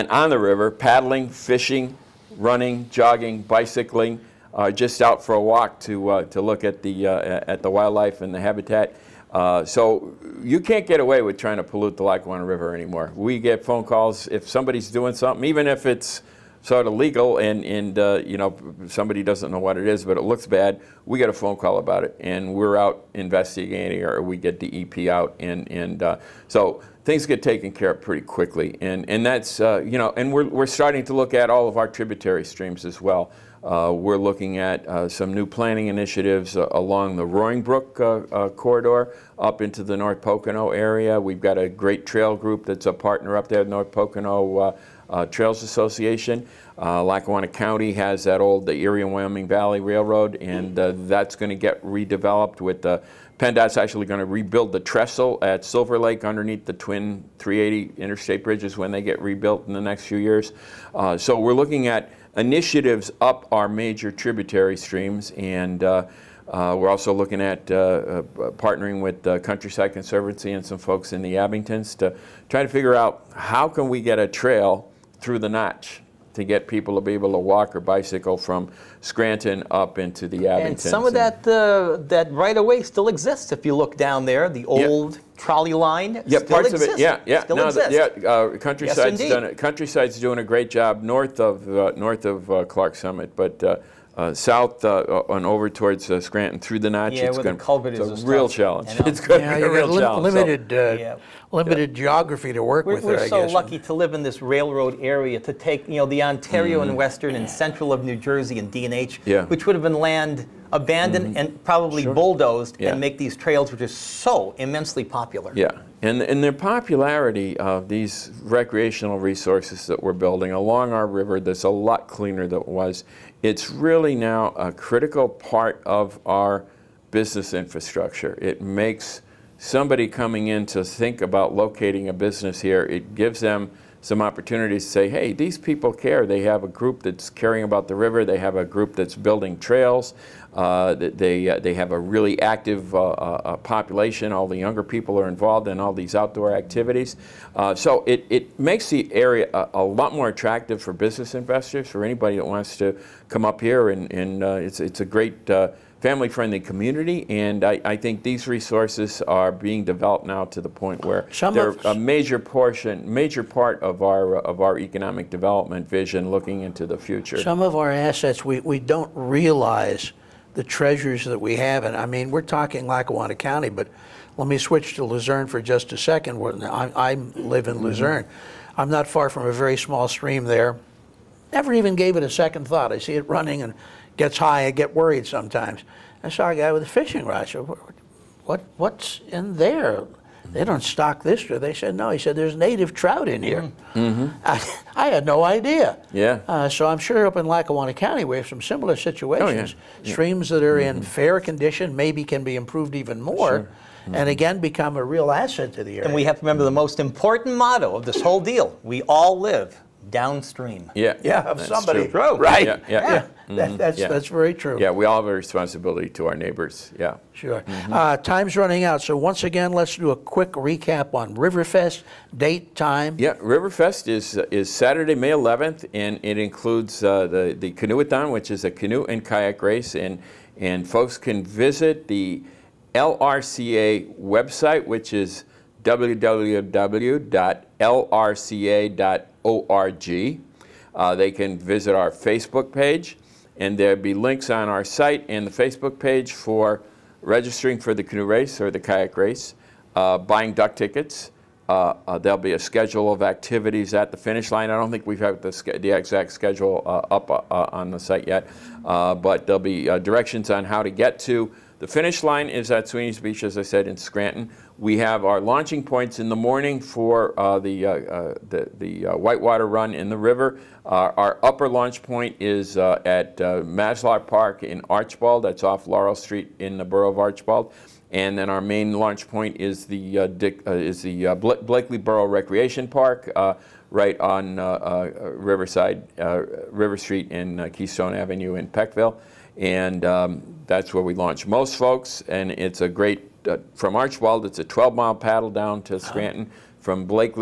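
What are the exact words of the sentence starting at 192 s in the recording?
He said, there's native trout in here.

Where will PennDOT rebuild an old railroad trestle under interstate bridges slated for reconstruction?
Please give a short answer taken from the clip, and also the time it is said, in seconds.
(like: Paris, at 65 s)
Silver Lake, at 55 s.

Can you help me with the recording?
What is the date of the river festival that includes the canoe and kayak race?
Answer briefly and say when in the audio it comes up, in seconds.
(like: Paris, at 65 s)
Saturday, May 11th, at 224 s.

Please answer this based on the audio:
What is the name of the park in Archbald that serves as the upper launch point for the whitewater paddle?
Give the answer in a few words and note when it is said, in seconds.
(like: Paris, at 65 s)
Maslar Park, at 273 s.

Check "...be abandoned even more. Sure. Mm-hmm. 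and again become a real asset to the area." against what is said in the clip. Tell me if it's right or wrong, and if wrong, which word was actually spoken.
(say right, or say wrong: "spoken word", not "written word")
wrong: "improved", not "abandoned".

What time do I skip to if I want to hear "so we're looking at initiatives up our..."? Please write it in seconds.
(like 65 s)
61 s.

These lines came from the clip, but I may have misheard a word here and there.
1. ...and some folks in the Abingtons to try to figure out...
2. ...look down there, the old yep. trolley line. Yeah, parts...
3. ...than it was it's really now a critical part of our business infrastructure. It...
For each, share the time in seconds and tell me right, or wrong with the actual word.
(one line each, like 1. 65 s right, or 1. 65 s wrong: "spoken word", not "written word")
1. 70 s right
2. 83 s right
3. 122 s right.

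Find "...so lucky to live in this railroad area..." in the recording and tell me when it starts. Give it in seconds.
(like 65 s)
103 s.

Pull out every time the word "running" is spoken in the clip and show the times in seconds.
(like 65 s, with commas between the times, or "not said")
2 s, 183 s, 218 s.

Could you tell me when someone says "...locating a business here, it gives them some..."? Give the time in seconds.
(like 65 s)
131 s.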